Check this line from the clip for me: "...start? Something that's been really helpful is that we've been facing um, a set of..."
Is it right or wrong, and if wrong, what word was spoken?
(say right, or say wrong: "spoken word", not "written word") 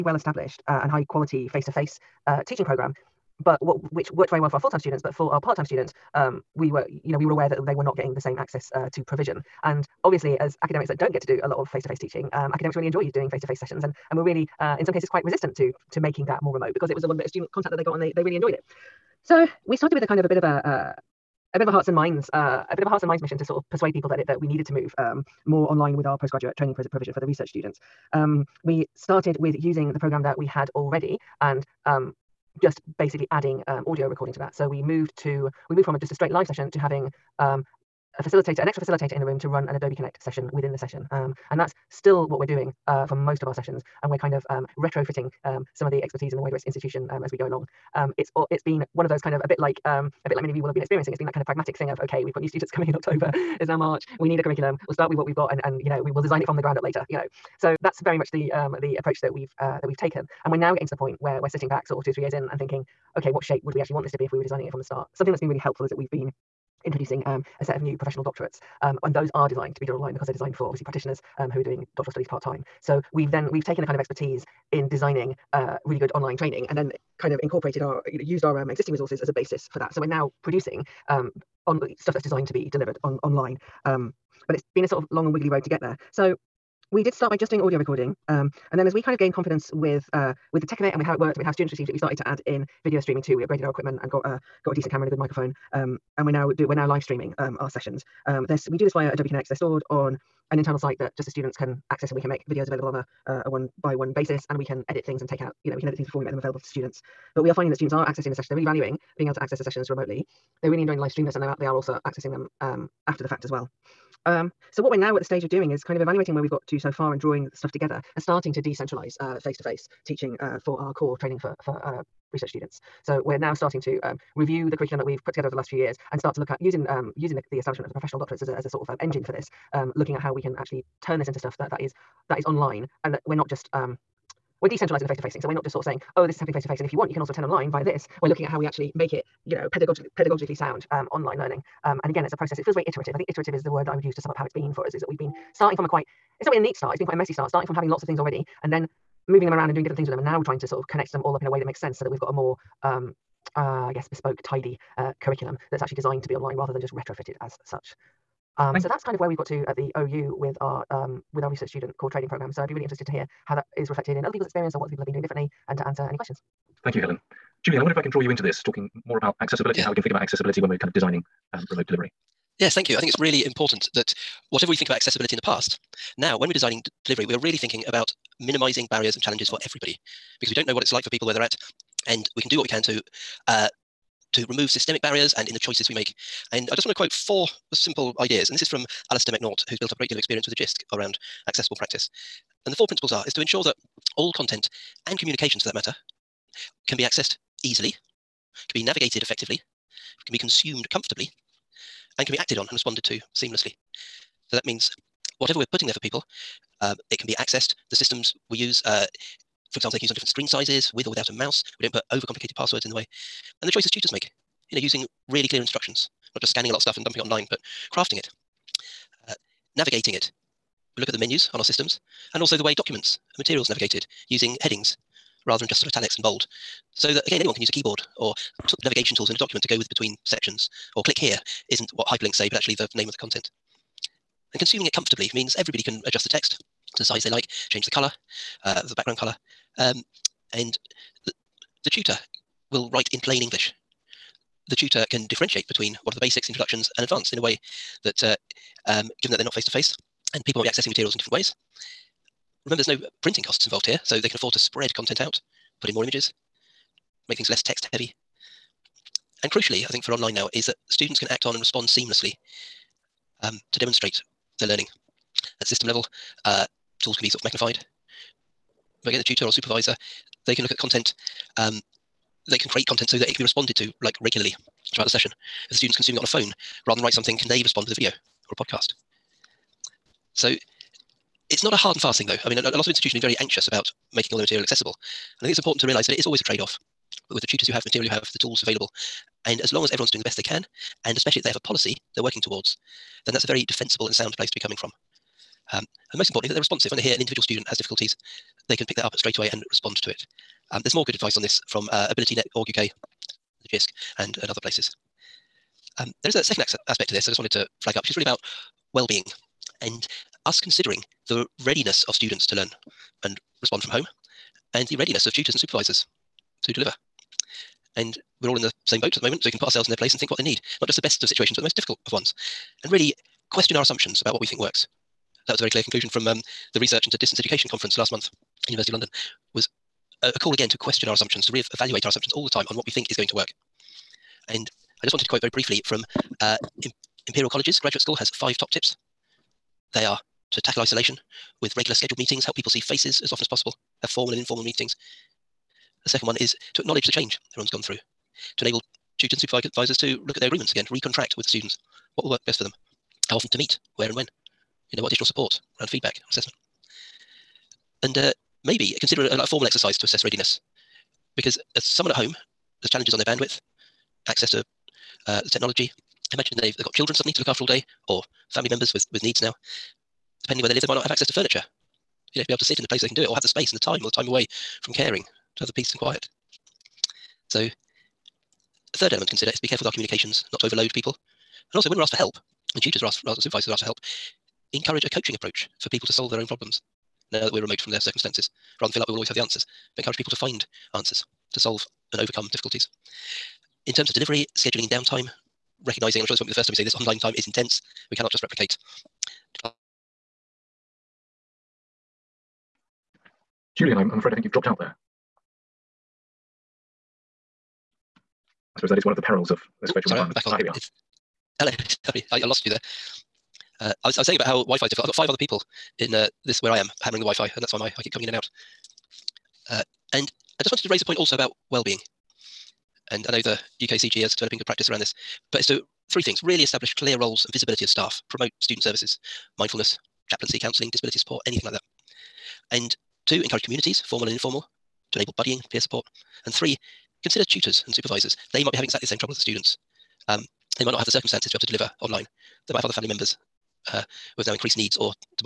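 wrong: "introducing", not "facing".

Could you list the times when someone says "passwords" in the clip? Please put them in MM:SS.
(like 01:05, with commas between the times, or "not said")
03:32.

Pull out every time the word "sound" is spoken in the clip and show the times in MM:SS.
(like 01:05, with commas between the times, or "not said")
02:20, 04:54.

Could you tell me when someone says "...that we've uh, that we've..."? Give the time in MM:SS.
00:59.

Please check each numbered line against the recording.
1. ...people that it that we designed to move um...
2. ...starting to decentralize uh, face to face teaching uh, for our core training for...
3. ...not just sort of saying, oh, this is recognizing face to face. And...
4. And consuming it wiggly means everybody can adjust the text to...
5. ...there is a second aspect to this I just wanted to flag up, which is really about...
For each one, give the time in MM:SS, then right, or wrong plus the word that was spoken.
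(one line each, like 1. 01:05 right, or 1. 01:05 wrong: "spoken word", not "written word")
1. 00:23 wrong: "needed", not "designed"
2. 01:58 right
3. 02:15 wrong: "happening", not "recognizing"
4. 03:54 wrong: "comfortably", not "wiggly"
5. 05:06 right.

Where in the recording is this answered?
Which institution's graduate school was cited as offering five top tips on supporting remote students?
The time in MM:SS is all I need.
05:37.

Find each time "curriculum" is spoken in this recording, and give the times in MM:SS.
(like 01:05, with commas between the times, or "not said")
00:54, 02:04, 02:35.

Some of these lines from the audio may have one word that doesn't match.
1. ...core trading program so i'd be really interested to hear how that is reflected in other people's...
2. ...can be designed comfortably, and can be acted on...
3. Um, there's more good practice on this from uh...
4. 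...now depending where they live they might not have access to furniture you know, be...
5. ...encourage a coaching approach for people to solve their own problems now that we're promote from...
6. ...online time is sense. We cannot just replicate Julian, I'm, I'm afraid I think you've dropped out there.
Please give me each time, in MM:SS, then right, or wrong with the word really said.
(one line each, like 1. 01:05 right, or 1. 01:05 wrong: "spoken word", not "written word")
1. 02:41 right
2. 03:20 wrong: "consumed", not "designed"
3. 05:00 wrong: "advice", not "practice"
4. 06:09 right
5. 06:24 wrong: "remote", not "promote"
6. 06:36 wrong: "intense", not "sense".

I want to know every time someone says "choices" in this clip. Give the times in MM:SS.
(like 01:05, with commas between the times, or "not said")
03:05, 03:33.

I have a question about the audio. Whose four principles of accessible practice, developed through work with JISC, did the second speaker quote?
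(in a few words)
Alistair McNaught.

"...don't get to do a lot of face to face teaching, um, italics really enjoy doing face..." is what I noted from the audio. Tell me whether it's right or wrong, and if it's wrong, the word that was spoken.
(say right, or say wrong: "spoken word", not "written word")
wrong: "academics", not "italics".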